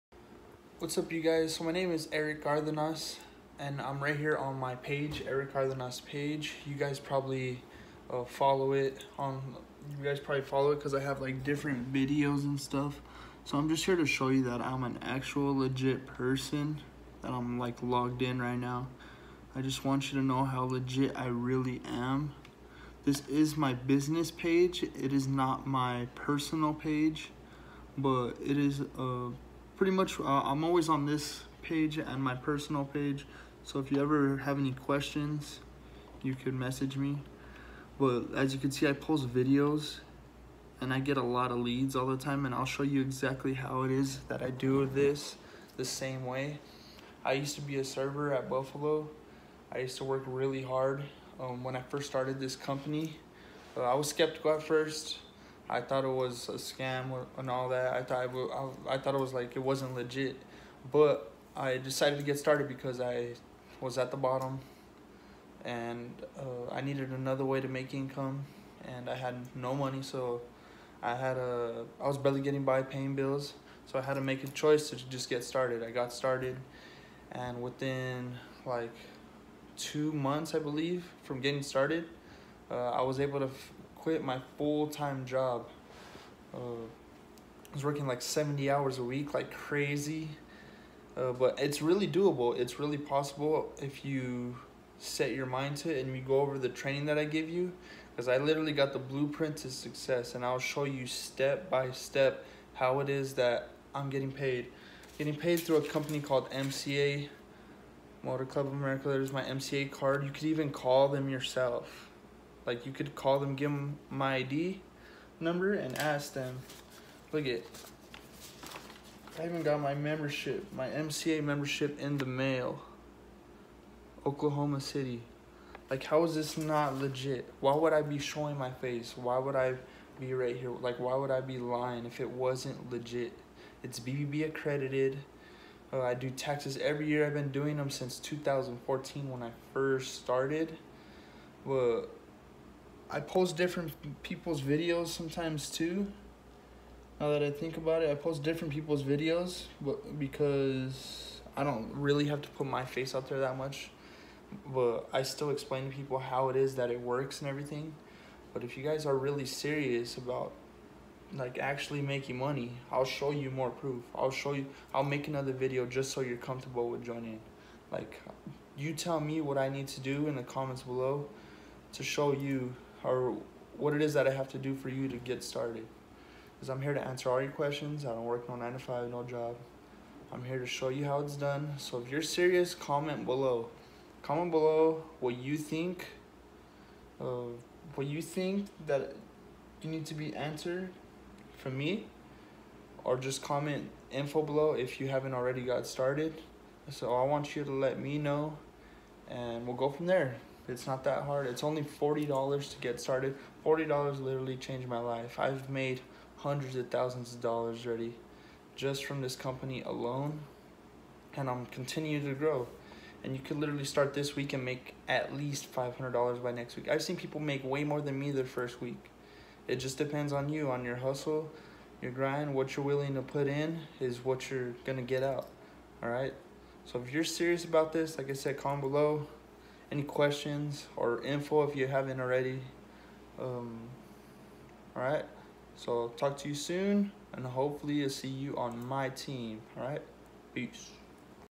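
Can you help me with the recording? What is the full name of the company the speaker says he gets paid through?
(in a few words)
Motor Club of America.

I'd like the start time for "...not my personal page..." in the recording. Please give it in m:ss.
0:25.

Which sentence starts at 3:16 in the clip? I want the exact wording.
So I want you to let me know and we'll go from there.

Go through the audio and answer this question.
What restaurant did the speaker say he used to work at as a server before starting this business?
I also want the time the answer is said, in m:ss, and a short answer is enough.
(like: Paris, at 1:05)
Buffalo, at 0:48.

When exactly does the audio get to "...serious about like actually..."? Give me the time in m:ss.
2:39.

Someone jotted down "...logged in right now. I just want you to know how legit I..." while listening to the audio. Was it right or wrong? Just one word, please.
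right.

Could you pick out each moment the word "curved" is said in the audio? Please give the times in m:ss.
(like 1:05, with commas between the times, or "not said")
not said.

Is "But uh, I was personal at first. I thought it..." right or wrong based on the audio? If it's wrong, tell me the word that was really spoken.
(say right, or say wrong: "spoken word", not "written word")
wrong: "skeptical", not "personal".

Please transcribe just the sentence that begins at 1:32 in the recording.
It's really possible if you set your mind to it and you go over the training that I give you.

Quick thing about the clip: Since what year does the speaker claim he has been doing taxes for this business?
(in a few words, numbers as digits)
2014.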